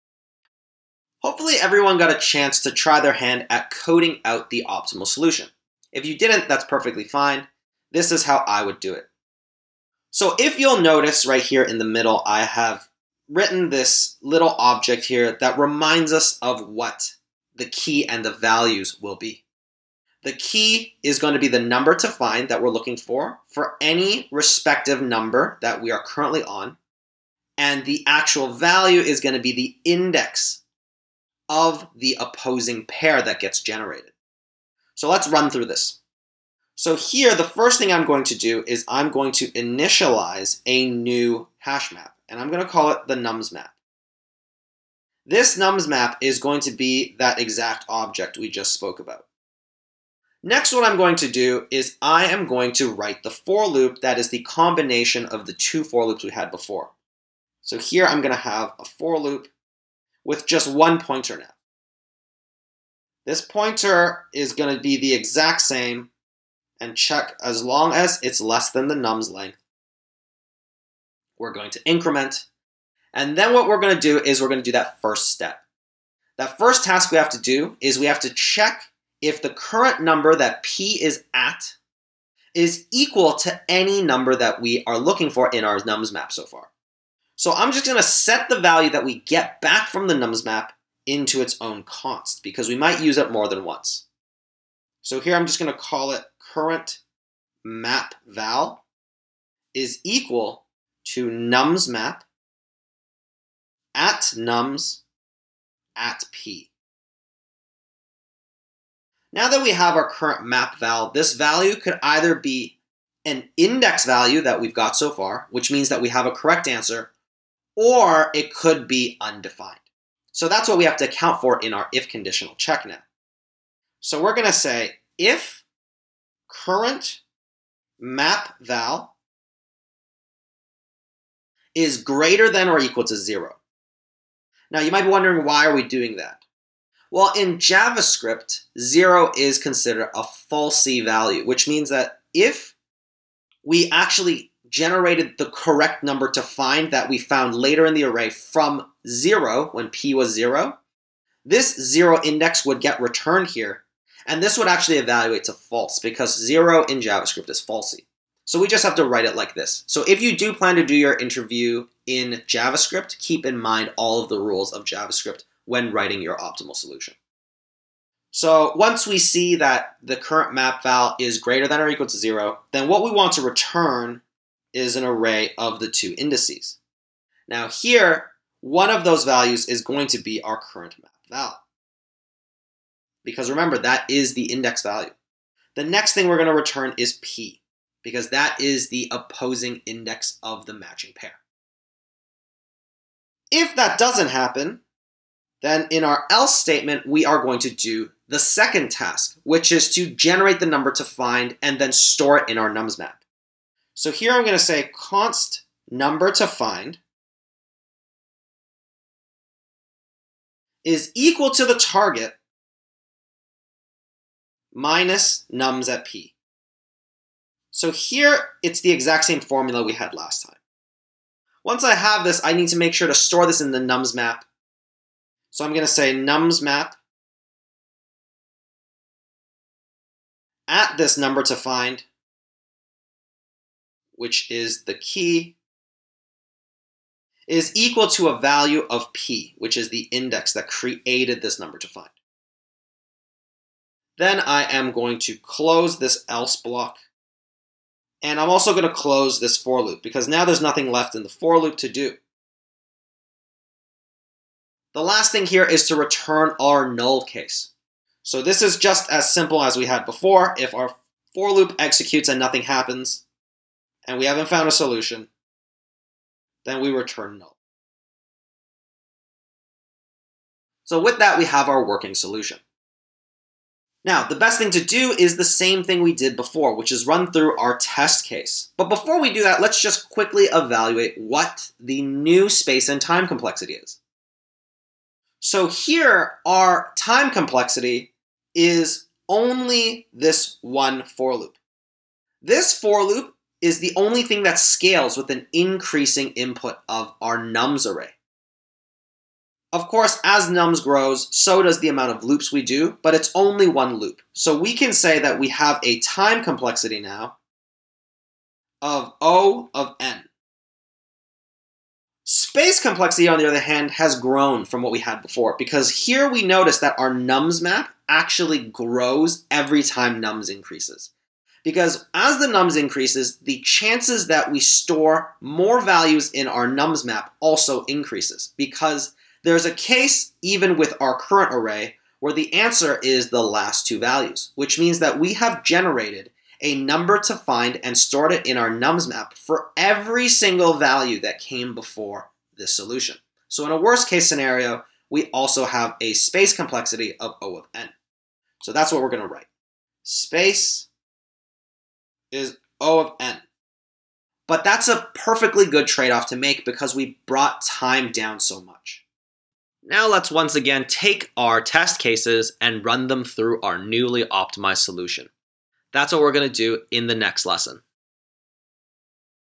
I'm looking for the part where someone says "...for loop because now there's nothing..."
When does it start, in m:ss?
4:09.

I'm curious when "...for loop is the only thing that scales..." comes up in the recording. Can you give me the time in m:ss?
4:52.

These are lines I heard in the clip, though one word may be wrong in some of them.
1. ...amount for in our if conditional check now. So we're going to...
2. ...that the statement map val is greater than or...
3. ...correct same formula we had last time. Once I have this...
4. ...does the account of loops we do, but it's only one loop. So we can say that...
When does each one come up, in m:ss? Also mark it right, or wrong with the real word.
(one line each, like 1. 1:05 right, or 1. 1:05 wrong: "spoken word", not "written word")
1. 2:01 wrong: "account", not "amount"
2. 2:49 wrong: "current", not "statement"
3. 3:38 wrong: "exact", not "correct"
4. 5:01 wrong: "amount", not "account".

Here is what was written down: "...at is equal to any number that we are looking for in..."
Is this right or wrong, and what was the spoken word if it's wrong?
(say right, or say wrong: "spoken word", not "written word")
right.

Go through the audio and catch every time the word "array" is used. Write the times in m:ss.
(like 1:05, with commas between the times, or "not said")
2:28, 2:55, 4:57, 5:31.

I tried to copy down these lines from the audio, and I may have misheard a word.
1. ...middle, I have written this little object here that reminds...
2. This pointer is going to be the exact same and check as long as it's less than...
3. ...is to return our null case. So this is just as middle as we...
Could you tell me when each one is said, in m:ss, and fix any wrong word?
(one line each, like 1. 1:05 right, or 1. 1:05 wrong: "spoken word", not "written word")
1. 0:11 right
2. 1:03 right
3. 4:15 wrong: "simple", not "middle".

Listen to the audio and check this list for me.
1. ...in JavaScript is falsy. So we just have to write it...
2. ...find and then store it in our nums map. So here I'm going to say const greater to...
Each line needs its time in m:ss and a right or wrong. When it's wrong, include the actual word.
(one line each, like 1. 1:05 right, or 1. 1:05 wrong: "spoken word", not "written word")
1. 2:36 right
2. 3:21 wrong: "number", not "greater".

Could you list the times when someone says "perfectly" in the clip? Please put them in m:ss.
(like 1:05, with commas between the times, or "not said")
0:06, 5:55.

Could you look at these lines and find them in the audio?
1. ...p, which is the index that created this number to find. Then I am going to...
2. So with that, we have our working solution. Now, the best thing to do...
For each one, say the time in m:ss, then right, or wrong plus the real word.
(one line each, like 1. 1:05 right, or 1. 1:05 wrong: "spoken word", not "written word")
1. 3:59 right
2. 4:30 right.